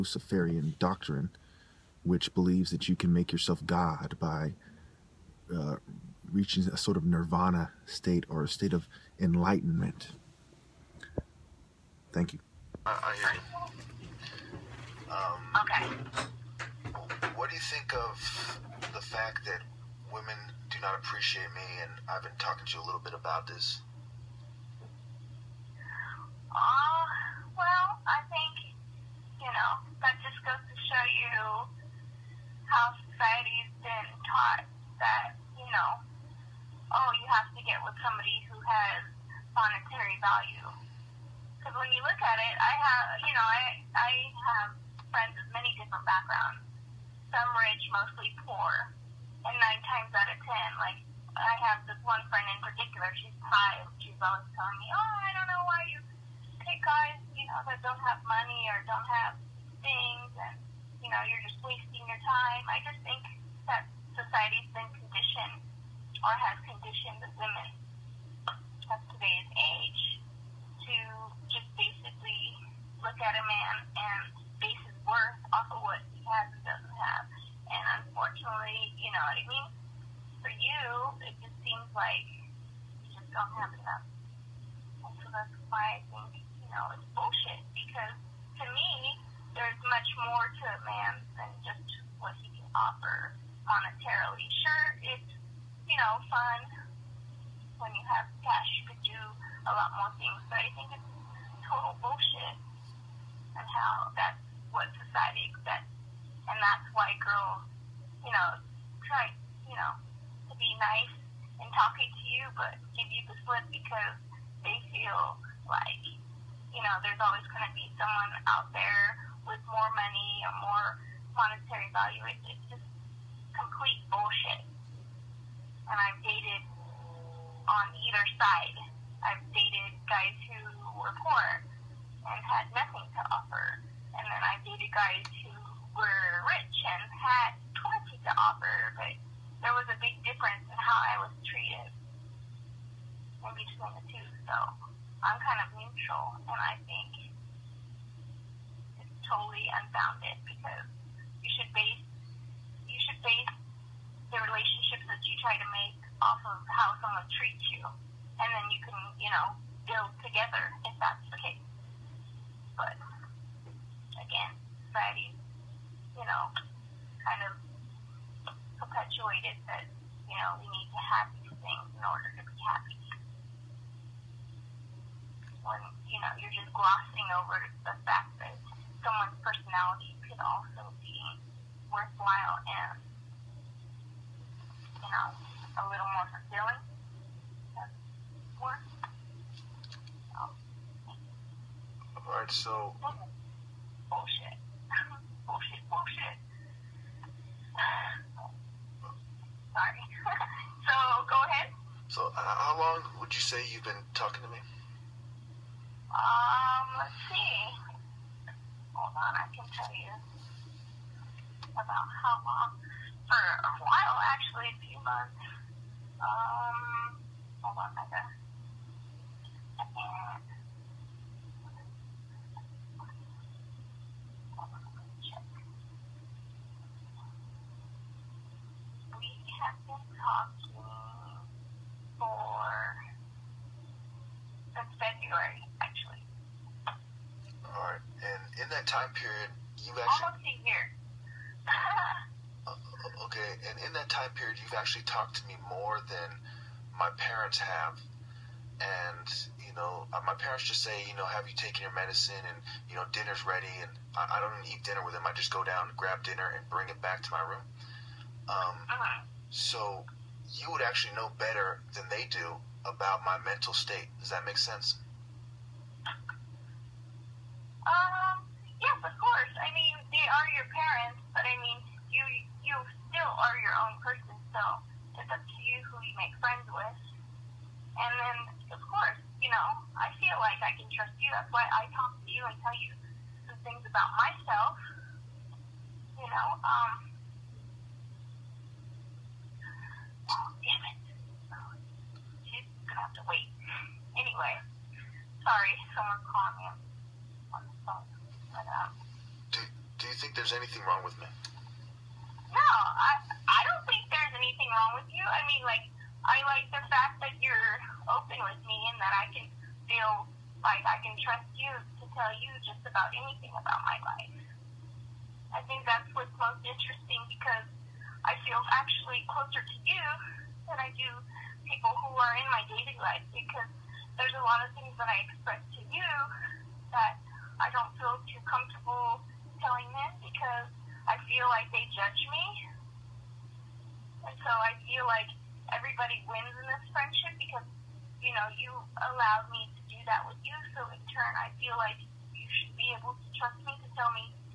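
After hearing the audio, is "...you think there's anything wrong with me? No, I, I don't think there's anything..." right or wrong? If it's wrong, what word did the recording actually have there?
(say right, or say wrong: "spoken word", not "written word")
right.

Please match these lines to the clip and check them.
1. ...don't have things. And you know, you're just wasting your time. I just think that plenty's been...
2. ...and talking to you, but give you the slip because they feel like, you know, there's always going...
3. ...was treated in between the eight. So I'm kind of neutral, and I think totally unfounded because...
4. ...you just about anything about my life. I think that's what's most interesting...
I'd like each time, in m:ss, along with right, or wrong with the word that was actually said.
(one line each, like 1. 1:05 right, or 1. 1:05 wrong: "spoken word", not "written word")
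1. 0:58 wrong: "society", not "plenty"
2. 1:51 right
3. 2:21 wrong: "two", not "eight"
4. 5:12 right.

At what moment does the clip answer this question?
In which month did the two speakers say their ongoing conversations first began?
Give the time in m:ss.
3:54.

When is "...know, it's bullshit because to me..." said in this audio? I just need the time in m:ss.
1:26.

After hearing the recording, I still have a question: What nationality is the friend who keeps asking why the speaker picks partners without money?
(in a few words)
Thai.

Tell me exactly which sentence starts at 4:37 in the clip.
And then, of course, you know, I feel like I can trust you.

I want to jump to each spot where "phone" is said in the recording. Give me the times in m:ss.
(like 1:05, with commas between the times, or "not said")
4:57.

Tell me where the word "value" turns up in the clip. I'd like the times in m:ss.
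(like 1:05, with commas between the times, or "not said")
0:40, 2:01.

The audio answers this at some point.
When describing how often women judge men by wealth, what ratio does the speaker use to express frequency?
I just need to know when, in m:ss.
0:49.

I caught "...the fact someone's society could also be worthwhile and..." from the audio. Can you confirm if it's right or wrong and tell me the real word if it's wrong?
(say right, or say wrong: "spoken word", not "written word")
wrong: "personality", not "society".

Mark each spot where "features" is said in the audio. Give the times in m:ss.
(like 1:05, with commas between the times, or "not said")
not said.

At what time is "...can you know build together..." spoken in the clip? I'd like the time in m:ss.
2:38.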